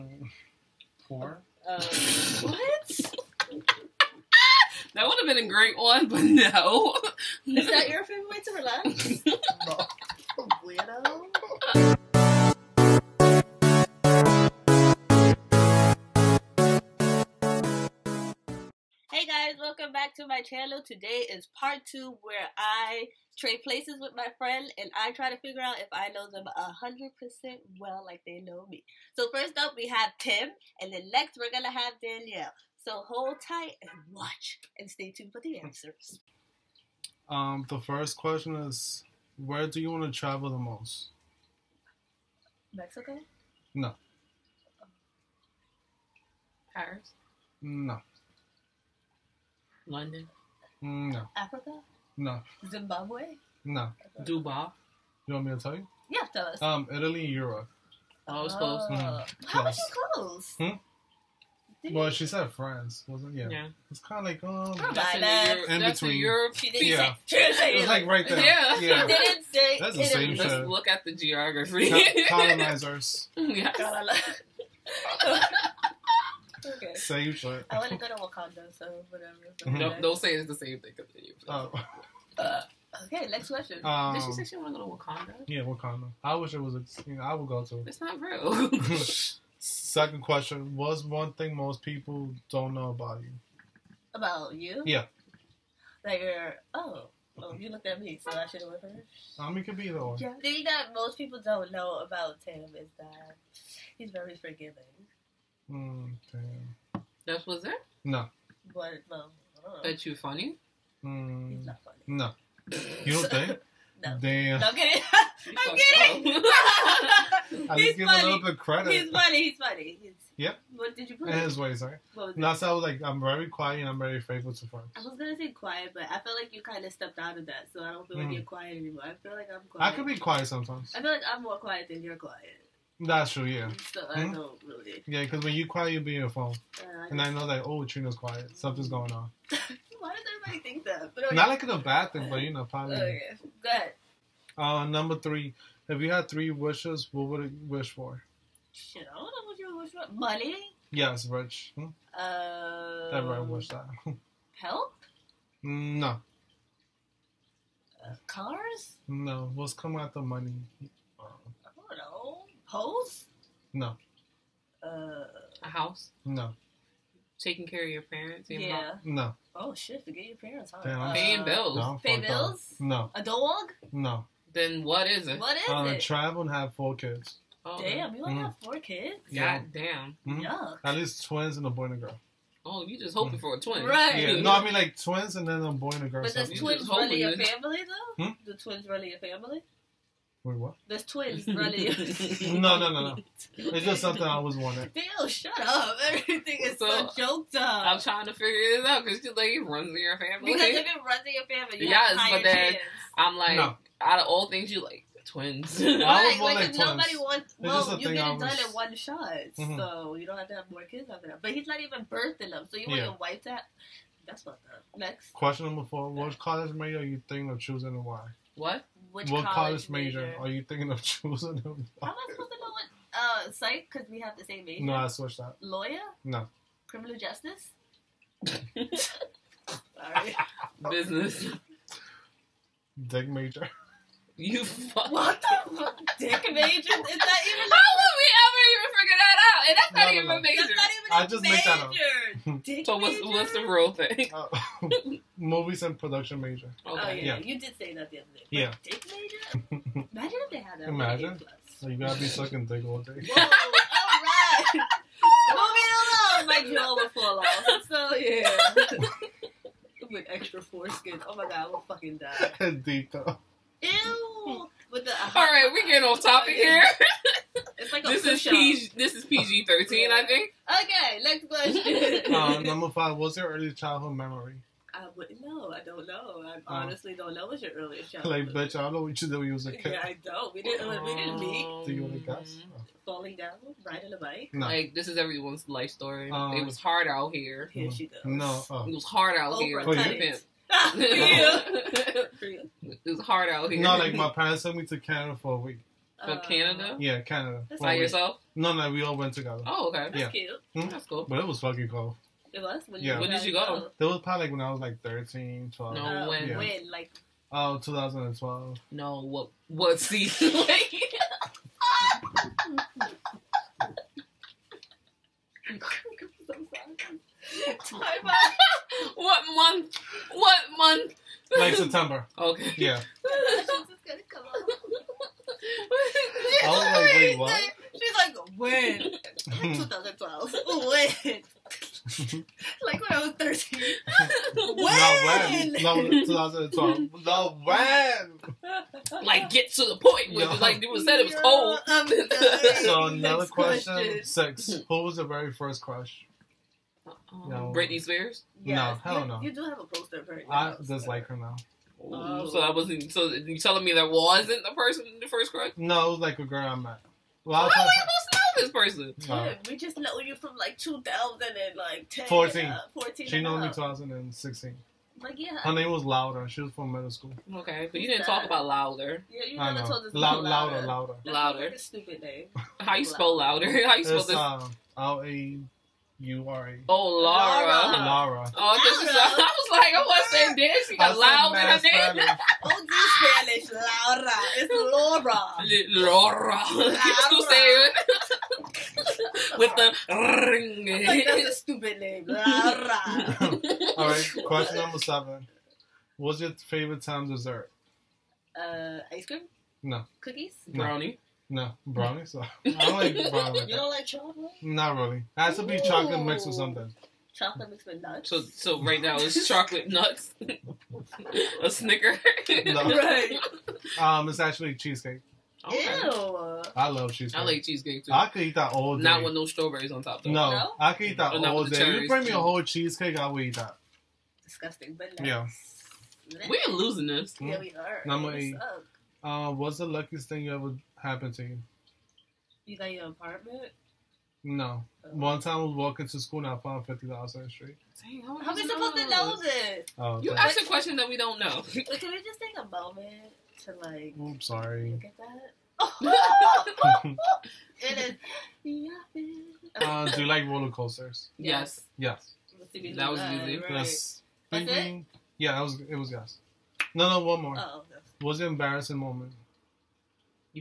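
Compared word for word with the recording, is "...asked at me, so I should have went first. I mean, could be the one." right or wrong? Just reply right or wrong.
wrong.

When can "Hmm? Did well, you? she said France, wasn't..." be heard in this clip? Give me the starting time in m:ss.
1:00.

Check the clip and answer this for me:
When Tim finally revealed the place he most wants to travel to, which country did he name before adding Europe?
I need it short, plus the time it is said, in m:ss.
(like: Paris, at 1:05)
Italy, at 0:56.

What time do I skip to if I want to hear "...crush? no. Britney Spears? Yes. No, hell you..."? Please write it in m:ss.
5:45.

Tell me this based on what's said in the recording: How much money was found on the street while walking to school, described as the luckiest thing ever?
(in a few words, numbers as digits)
$50.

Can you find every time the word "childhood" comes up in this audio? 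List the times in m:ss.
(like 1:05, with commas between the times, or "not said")
4:33, 4:38.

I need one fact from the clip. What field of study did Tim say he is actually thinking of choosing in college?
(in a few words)
Movies and production.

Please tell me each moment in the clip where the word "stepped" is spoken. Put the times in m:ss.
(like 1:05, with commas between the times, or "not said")
2:06.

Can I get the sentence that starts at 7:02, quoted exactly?
you bring me a whole cheesecake, I will eat that.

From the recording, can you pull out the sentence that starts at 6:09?
Yeah, you never told us Lou- Louder.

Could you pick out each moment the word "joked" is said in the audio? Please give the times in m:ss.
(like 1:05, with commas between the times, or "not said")
3:17.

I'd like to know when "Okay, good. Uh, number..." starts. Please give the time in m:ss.
2:22.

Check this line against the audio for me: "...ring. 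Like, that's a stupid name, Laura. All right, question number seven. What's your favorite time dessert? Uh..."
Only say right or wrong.
right.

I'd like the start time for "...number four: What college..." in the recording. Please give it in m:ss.
3:35.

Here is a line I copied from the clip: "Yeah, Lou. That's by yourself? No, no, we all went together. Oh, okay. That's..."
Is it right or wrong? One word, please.
wrong.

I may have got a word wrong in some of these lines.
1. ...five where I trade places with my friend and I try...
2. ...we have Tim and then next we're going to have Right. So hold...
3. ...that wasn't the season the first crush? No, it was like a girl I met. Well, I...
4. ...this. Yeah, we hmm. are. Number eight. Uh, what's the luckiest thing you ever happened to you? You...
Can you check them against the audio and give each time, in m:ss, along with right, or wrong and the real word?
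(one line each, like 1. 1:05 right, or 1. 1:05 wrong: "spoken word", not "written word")
1. 0:21 wrong: "two", not "five"
2. 0:29 wrong: "Danielle", not "Right"
3. 5:53 wrong: "person", not "season"
4. 7:07 right.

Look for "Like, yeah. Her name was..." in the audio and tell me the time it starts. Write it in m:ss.
6:05.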